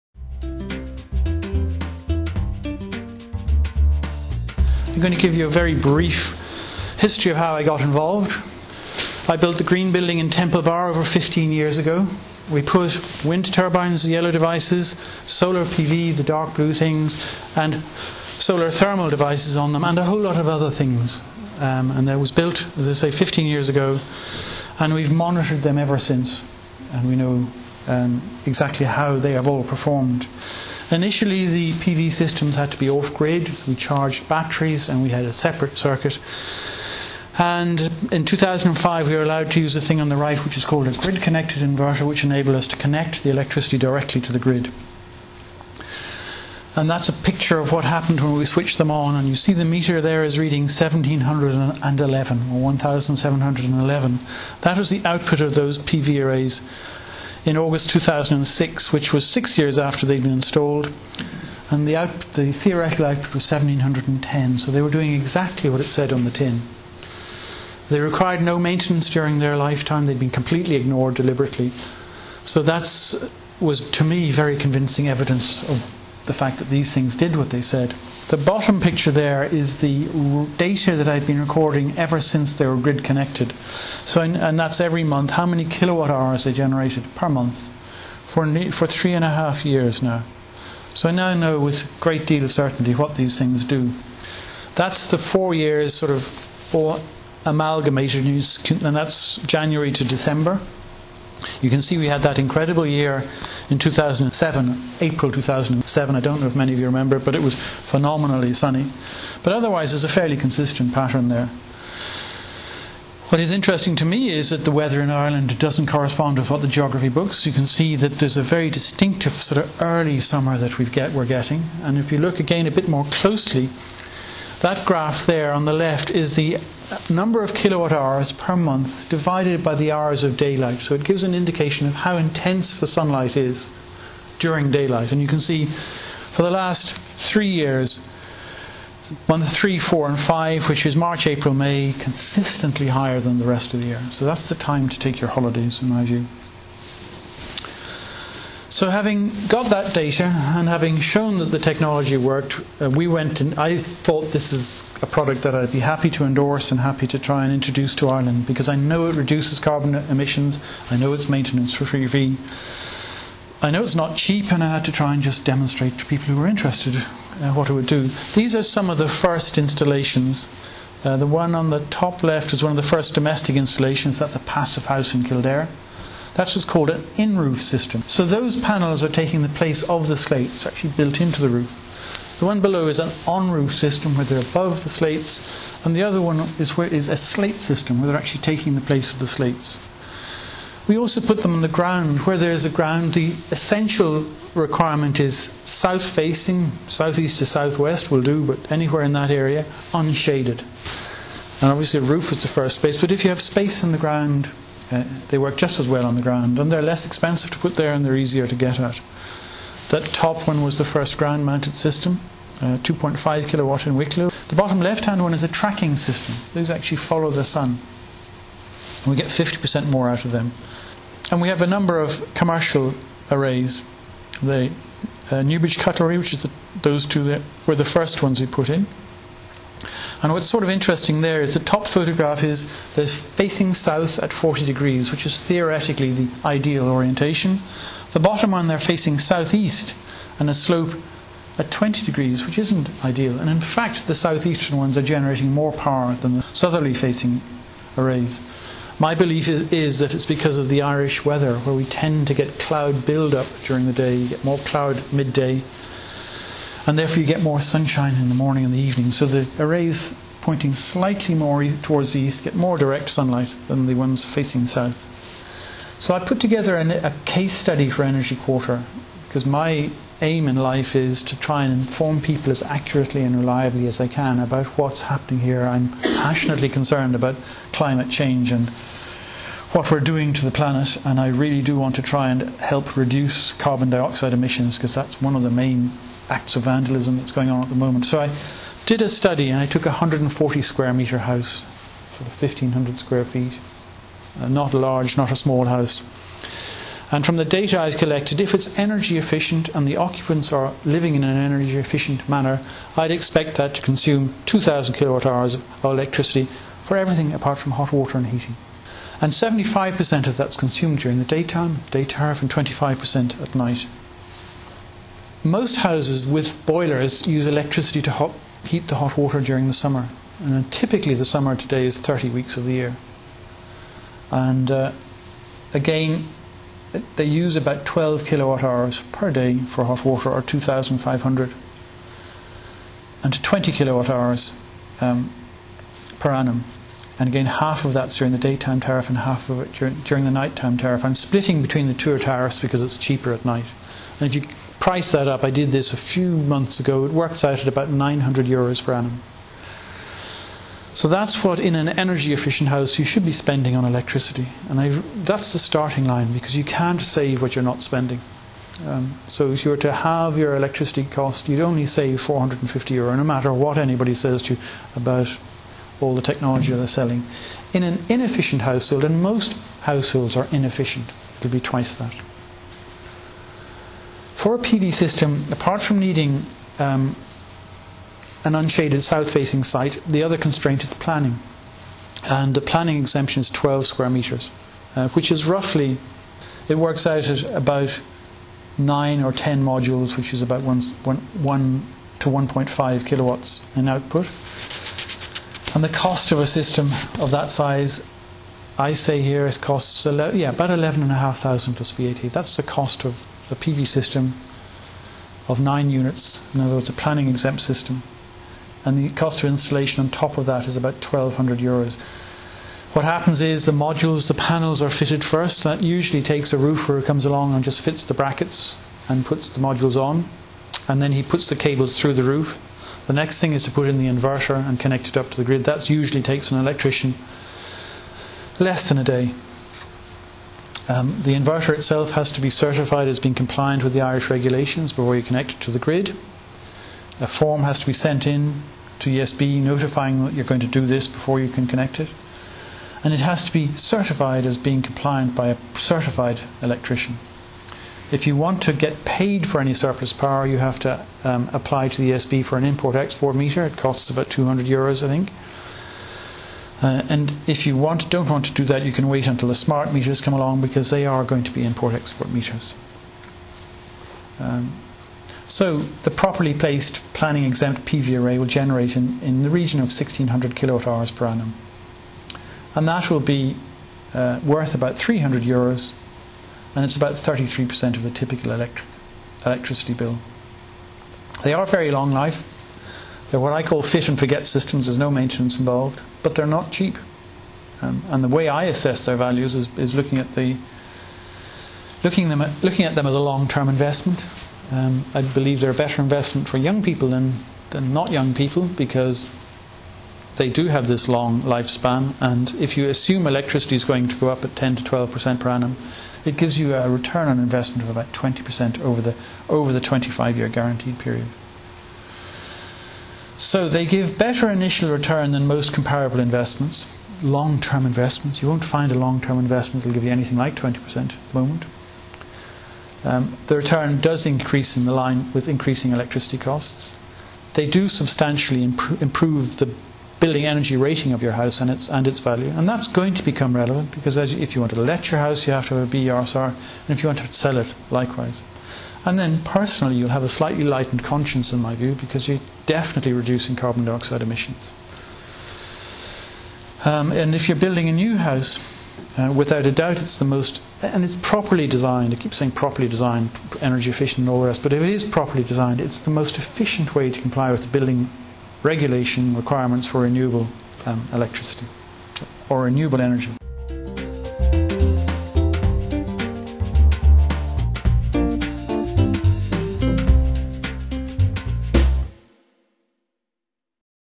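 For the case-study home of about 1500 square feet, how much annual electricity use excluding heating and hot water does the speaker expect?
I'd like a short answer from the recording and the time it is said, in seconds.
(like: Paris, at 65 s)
2,000 kilowatt hours, at 304 s.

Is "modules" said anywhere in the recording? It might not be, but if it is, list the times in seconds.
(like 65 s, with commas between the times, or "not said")
389 s, 413 s, 419 s.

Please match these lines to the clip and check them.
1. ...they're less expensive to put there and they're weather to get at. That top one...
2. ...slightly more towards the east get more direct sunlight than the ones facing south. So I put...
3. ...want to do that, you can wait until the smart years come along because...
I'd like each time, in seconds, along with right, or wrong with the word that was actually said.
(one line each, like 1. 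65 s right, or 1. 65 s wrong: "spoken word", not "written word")
1. 206 s wrong: "easier", not "weather"
2. 260 s right
3. 458 s wrong: "meters", not "years".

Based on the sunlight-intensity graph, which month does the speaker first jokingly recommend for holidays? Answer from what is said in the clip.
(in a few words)
March.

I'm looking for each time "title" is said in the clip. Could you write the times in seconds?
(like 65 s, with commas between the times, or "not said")
not said.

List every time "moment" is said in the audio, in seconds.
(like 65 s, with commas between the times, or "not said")
287 s, 521 s.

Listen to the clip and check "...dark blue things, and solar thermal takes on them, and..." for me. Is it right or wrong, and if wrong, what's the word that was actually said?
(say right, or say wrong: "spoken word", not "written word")
wrong: "devices", not "takes".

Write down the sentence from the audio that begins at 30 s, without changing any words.
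Initially, the PV systems had to be off grid.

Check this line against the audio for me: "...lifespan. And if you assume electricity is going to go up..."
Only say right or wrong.
right.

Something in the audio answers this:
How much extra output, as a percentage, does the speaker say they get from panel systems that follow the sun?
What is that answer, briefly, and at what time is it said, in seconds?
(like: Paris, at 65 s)
50%, at 219 s.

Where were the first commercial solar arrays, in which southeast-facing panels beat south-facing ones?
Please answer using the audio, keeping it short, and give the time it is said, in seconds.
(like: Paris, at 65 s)
Newbridge Cutlery, at 225 s.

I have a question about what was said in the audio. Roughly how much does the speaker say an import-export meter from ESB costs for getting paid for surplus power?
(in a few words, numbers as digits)
200 euros.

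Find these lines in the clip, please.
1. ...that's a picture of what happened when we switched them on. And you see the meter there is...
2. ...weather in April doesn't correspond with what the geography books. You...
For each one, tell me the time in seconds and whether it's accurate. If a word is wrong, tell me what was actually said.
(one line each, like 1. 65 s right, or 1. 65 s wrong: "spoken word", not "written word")
1. 46 s right
2. 114 s wrong: "Ireland", not "April".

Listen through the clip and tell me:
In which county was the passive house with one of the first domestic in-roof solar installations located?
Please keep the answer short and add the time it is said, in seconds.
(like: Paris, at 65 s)
Kildare, at 175 s.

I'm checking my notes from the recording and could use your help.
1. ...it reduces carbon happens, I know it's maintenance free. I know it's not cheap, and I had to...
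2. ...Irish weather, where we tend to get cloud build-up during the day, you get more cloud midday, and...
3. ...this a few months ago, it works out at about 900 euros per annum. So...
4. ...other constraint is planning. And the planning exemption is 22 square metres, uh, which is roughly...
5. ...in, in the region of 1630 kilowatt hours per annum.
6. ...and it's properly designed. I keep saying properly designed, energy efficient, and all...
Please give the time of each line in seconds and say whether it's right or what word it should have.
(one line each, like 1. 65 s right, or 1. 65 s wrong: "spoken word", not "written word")
1. 159 s wrong: "emissions", not "happens"
2. 250 s right
3. 345 s right
4. 380 s wrong: "12", not "22"
5. 468 s wrong: "1600", not "1630"
6. 550 s right.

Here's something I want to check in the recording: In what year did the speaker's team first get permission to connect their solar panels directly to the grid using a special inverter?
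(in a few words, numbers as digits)
2005.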